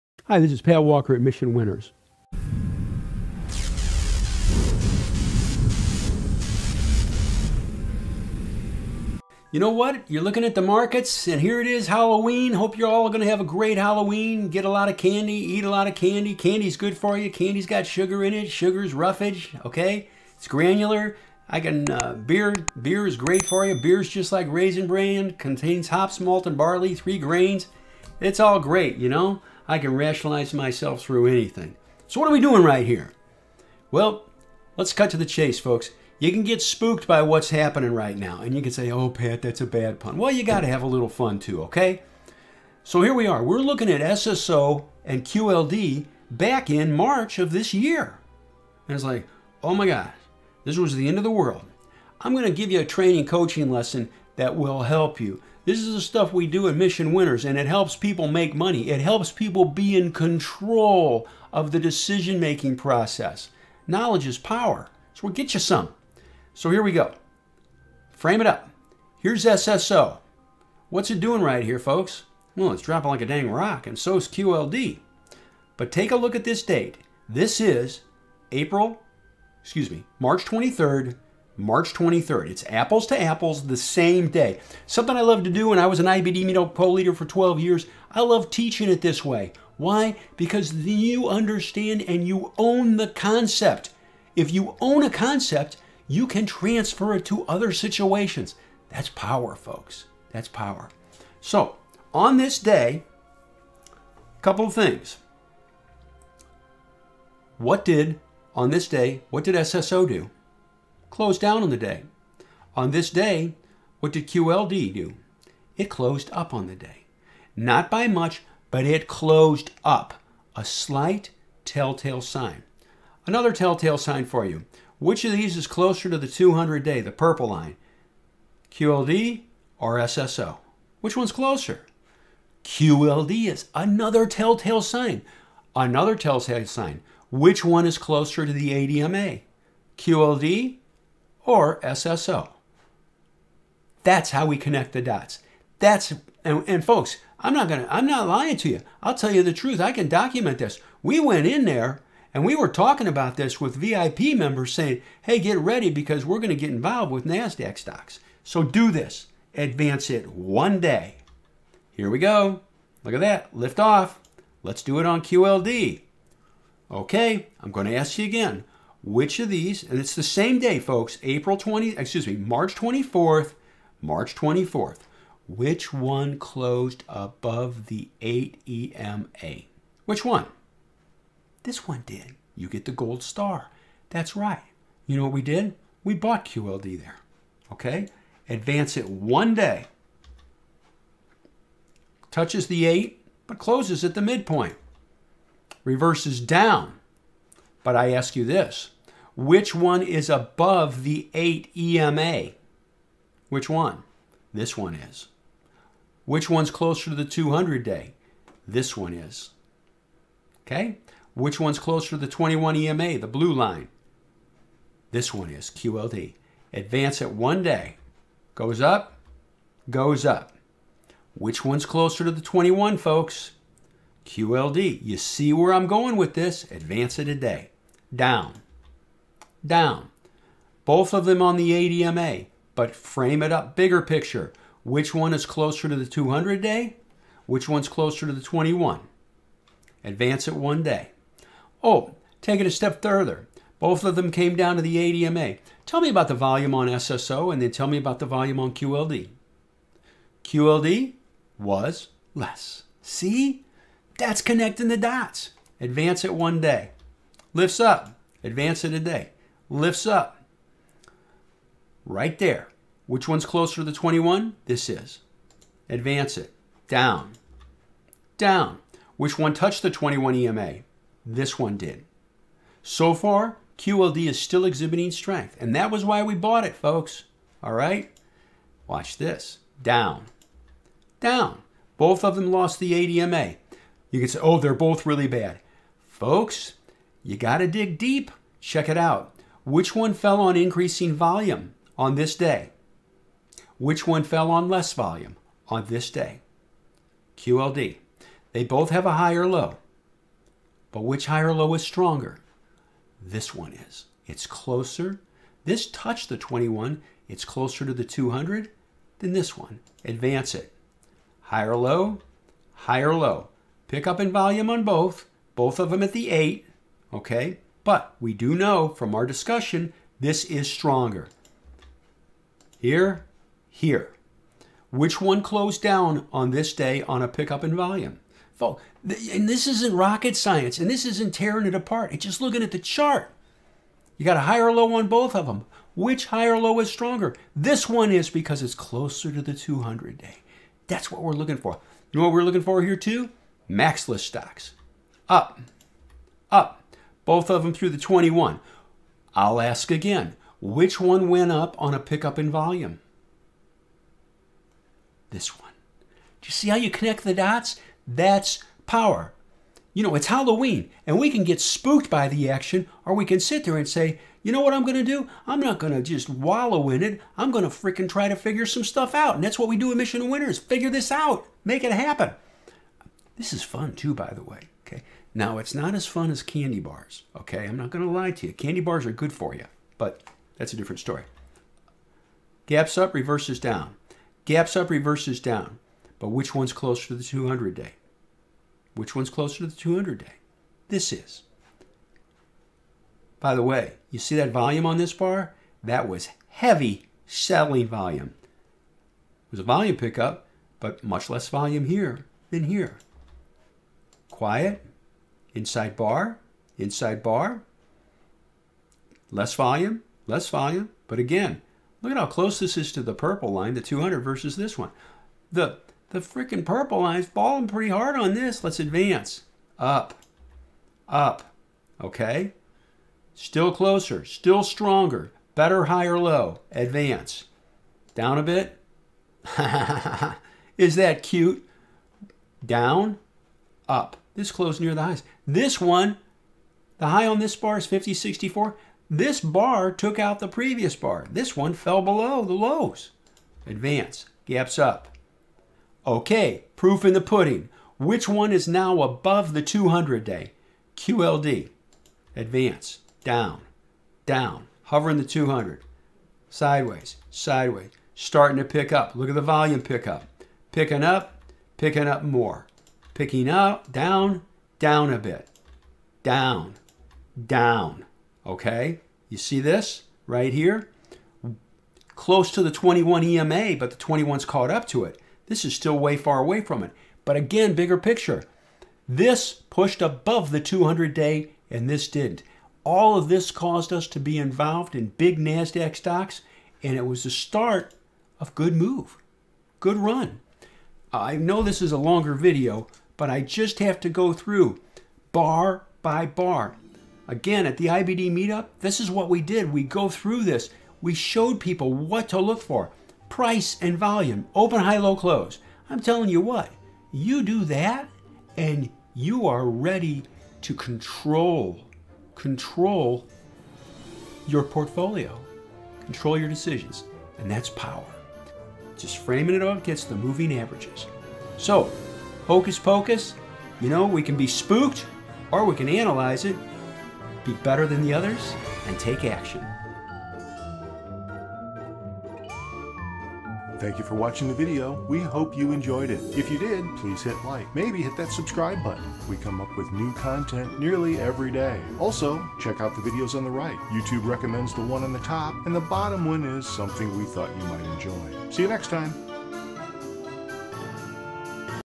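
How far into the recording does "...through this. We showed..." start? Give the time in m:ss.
8:20.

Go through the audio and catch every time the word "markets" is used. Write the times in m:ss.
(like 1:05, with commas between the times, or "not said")
0:10.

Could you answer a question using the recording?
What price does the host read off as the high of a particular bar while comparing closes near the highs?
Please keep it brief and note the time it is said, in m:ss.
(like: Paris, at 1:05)
fifty sixty four, at 7:17.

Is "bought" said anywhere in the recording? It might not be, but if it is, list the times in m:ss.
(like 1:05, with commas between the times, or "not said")
3:06, 4:36.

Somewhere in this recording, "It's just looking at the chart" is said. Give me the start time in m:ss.
5:32.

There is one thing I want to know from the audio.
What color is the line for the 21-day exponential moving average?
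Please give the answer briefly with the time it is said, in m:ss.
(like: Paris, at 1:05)
blue, at 3:33.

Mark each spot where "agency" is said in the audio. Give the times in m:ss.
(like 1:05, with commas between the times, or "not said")
not said.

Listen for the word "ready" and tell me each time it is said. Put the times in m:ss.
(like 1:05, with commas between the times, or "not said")
2:35, 8:29.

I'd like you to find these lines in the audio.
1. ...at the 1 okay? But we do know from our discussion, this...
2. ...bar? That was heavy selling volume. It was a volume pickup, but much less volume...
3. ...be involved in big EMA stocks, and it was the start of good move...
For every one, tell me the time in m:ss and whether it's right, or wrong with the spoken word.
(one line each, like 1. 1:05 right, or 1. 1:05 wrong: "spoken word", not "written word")
1. 5:16 wrong: "8", not "1"
2. 6:35 right
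3. 8:04 wrong: "NASDAQ", not "EMA".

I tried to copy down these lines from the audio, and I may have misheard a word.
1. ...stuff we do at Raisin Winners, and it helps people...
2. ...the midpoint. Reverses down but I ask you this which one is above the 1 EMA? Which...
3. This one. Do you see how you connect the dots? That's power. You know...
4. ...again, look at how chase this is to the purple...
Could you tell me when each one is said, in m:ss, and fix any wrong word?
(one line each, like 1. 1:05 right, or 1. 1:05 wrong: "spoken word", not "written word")
1. 0:56 wrong: "Mission", not "Raisin"
2. 3:14 wrong: "8", not "1"
3. 5:55 right
4. 6:51 wrong: "close", not "chase".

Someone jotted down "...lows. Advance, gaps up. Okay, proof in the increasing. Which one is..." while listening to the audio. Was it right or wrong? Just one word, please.
wrong.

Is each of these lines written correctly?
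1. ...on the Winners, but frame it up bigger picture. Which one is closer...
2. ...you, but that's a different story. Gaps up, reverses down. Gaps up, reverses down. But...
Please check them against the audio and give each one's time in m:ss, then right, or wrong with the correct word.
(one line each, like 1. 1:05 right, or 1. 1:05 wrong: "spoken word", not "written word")
1. 3:51 wrong: "ADMA", not "Winners"
2. 6:19 right.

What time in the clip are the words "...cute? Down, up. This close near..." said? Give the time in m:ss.
7:11.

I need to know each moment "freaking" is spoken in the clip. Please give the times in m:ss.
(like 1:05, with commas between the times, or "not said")
6:07, 6:56.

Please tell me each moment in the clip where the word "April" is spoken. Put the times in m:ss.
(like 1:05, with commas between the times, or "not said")
1:18, 2:51.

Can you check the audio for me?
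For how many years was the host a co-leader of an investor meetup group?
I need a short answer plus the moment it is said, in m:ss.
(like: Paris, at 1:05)
12, at 1:27.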